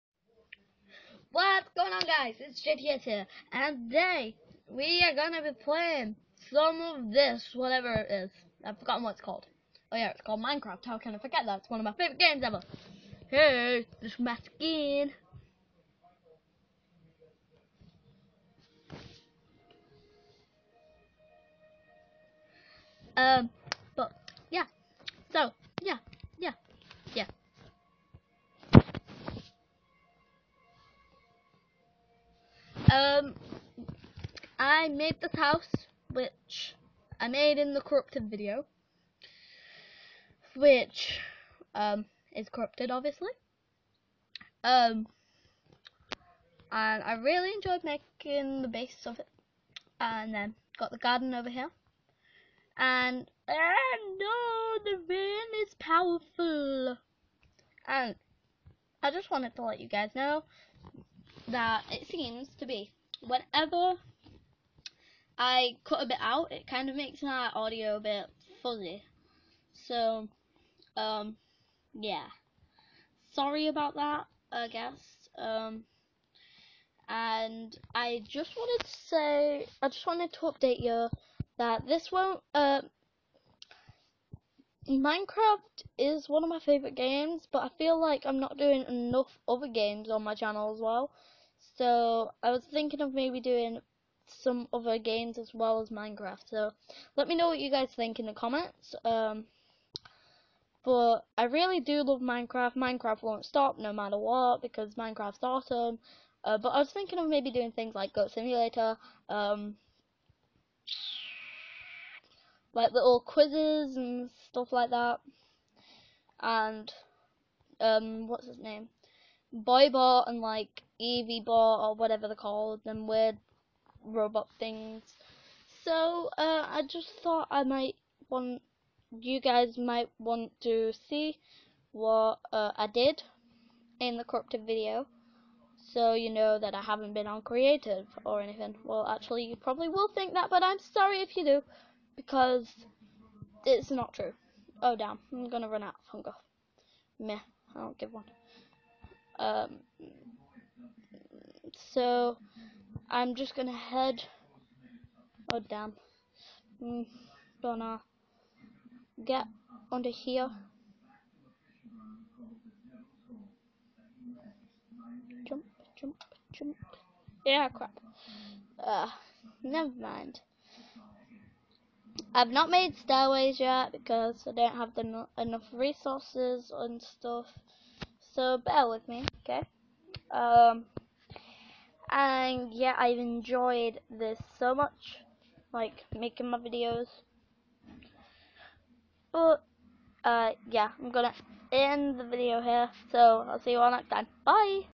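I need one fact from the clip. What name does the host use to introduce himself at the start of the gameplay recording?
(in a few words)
JTS.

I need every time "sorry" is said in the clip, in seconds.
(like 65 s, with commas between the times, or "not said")
73 s, 140 s.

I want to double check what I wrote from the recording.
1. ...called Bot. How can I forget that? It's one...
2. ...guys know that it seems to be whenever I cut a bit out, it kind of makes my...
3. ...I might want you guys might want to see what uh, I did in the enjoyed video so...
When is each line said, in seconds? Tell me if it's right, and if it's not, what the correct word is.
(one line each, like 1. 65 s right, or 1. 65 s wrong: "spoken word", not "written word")
1. 10 s wrong: "Minecraft", not "Bot"
2. 59 s right
3. 127 s wrong: "corrupted", not "enjoyed".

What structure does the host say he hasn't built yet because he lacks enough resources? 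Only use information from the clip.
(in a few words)
Stairways.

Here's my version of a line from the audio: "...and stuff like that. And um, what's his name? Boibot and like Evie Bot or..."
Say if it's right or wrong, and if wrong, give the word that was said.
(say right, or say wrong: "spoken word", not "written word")
right.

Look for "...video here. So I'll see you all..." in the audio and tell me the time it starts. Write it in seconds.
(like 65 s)
192 s.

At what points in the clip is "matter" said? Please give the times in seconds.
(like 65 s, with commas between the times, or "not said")
103 s.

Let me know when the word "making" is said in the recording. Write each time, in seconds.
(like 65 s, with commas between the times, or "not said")
47 s, 186 s.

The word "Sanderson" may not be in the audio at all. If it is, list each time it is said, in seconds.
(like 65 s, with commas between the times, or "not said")
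not said.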